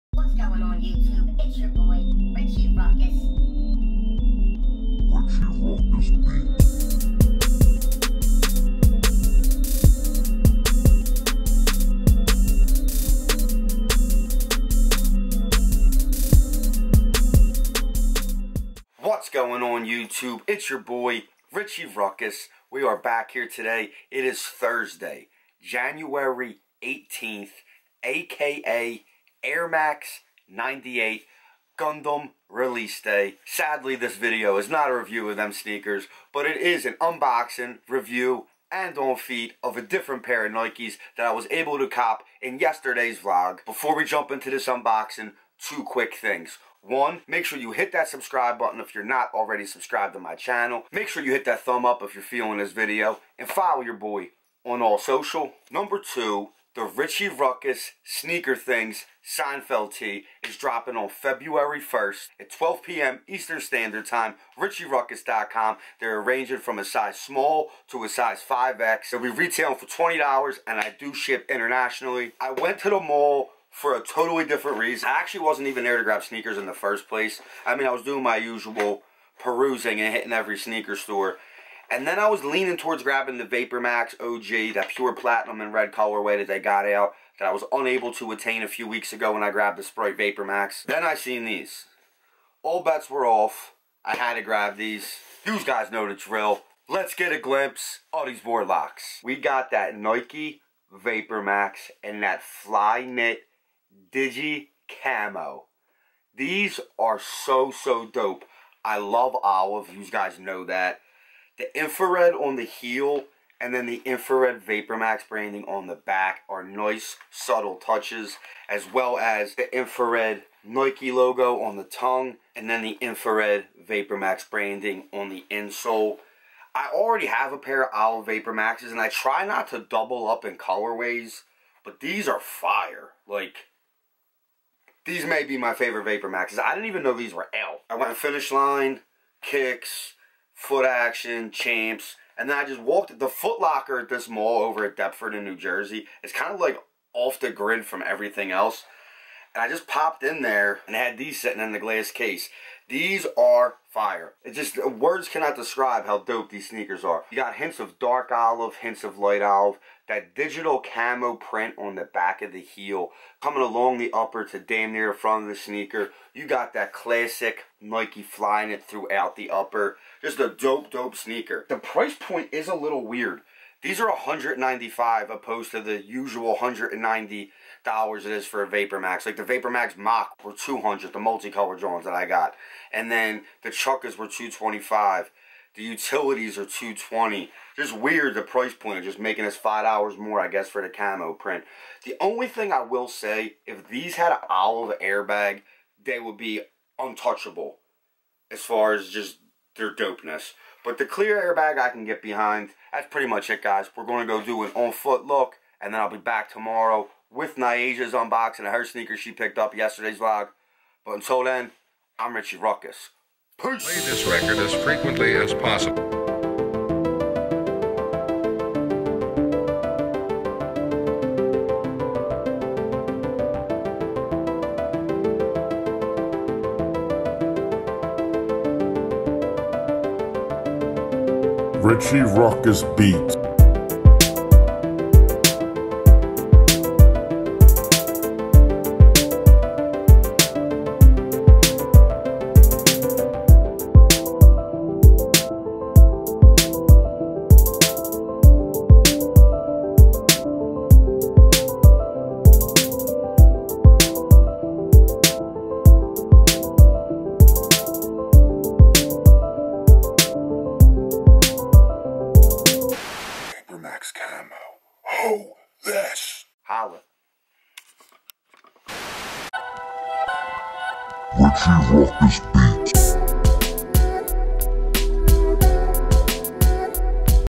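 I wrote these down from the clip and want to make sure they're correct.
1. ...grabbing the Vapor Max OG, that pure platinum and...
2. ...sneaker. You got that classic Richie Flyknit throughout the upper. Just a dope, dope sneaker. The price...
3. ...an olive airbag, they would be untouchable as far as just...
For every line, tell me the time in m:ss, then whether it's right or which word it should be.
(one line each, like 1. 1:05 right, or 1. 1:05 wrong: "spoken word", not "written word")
1. 1:23 right
2. 2:45 wrong: "Nike", not "Richie"
3. 3:14 right.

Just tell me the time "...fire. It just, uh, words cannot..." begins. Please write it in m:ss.
2:33.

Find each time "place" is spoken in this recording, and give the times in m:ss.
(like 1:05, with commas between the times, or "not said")
1:17.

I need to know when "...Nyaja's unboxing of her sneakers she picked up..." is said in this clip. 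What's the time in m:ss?
3:27.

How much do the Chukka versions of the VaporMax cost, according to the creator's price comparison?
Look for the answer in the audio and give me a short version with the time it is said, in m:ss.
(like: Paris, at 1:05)
$225, at 3:04.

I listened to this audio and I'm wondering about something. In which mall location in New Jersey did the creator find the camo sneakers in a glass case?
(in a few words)
Deptford.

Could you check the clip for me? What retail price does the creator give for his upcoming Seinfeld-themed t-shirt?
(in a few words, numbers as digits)
$20.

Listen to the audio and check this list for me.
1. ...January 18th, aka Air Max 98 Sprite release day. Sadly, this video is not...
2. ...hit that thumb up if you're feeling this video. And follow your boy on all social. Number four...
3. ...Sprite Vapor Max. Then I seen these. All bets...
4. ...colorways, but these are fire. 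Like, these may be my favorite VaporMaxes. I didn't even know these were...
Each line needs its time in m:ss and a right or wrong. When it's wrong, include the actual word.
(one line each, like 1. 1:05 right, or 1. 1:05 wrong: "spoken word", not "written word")
1. 0:25 wrong: "Gundam", not "Sprite"
2. 0:51 wrong: "two", not "four"
3. 1:29 right
4. 2:10 right.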